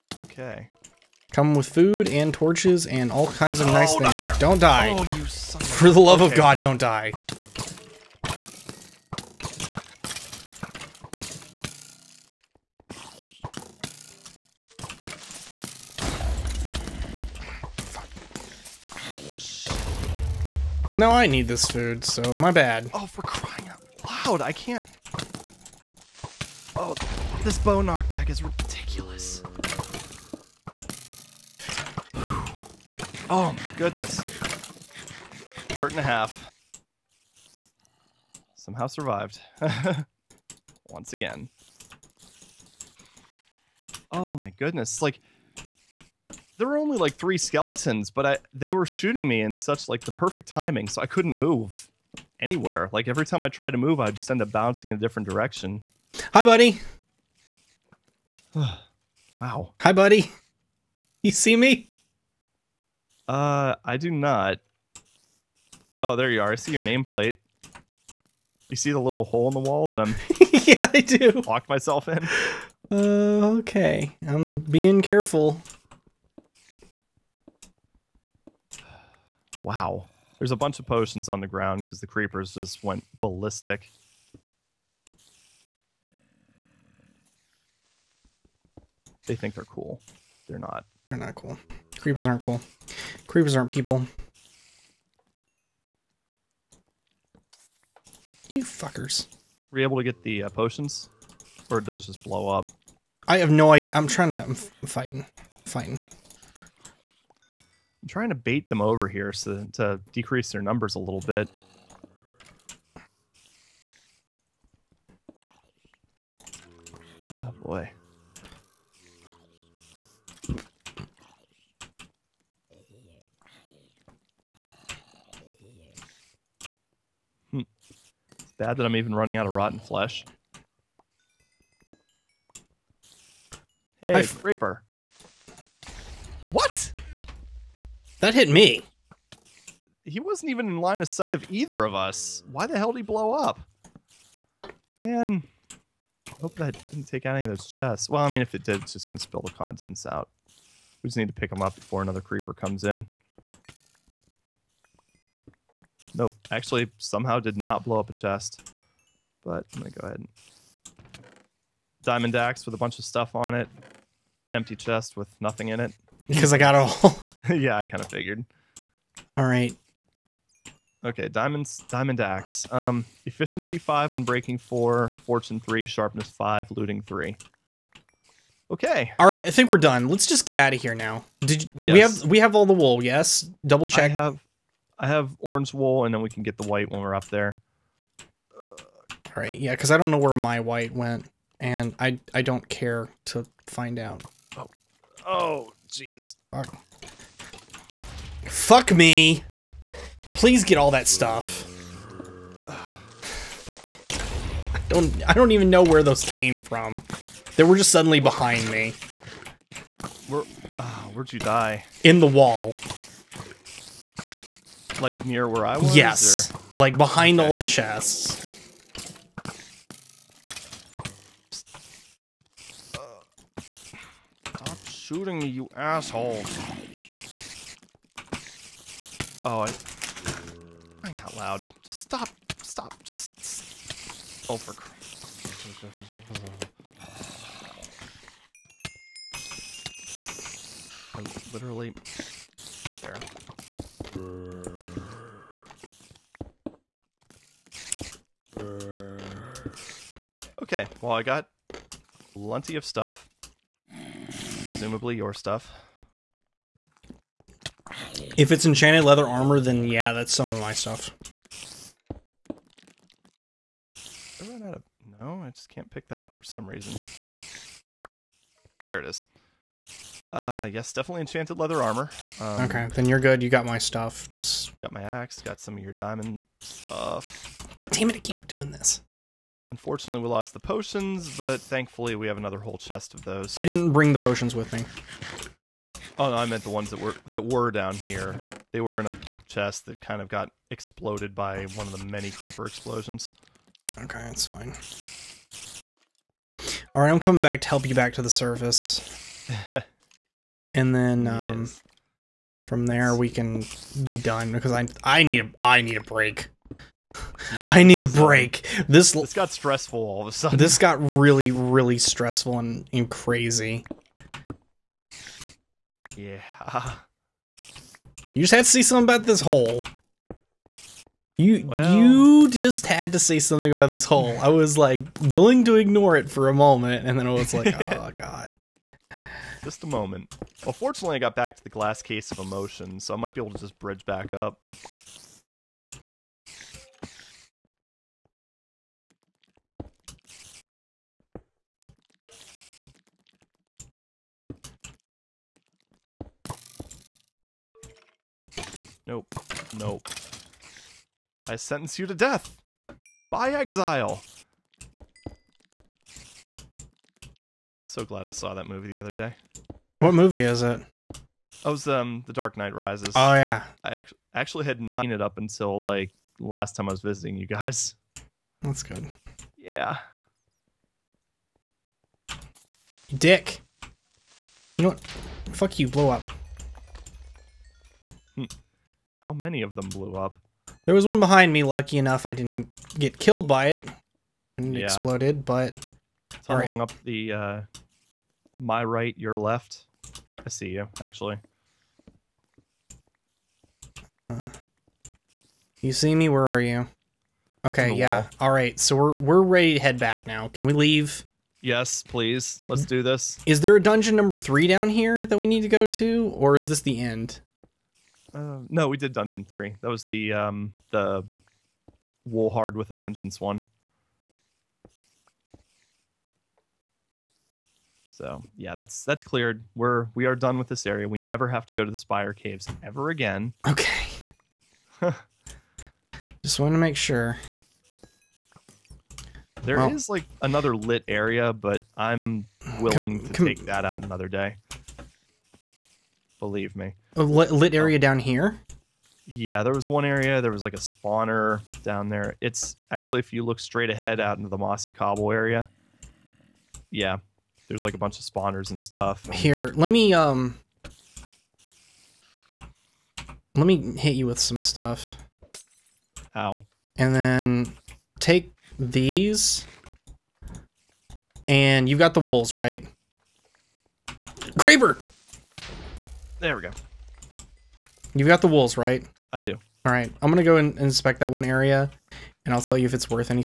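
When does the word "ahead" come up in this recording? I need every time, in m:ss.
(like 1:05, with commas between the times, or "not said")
2:40, 7:23.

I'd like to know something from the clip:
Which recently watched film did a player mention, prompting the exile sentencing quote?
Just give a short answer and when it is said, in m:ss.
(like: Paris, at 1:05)
The Dark Knight Rises, at 6:02.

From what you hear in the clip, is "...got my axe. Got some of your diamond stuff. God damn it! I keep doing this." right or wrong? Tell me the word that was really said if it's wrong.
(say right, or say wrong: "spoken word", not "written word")
right.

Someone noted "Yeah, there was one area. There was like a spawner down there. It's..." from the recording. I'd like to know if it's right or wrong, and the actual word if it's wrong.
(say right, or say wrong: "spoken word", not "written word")
right.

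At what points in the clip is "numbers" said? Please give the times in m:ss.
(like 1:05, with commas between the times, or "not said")
1:50, 6:44.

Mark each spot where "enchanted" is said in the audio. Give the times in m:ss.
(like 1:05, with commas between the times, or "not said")
4:18, 4:31.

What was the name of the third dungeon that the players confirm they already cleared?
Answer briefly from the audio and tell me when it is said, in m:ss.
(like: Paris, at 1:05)
Woolhard with a Vengeance, at 6:52.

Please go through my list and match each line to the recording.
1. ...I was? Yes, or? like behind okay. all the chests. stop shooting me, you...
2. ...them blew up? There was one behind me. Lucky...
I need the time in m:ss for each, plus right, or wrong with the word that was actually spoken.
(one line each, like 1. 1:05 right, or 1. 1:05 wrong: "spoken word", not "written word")
1. 3:35 right
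2. 6:19 right.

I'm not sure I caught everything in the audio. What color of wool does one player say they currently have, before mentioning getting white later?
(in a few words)
Orange.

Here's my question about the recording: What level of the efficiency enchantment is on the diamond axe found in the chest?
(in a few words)
5.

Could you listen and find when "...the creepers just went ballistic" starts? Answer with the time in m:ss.
1:22.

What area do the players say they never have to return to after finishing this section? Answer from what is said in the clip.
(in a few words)
Spire Caves.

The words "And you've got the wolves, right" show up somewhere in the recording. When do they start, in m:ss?
7:41.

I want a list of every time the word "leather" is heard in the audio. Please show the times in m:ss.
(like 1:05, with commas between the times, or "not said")
4:19, 4:31.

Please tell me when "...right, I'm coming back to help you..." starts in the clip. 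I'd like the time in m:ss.
4:57.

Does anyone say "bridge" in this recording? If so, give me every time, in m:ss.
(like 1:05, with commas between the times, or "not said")
5:33.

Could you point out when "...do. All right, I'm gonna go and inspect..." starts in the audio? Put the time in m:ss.
7:49.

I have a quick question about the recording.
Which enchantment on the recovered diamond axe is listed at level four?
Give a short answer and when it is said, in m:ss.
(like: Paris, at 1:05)
Unbreaking, at 2:54.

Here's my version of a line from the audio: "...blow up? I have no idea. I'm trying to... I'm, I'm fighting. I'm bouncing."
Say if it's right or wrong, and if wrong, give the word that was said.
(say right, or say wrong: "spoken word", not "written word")
wrong: "fighting", not "bouncing".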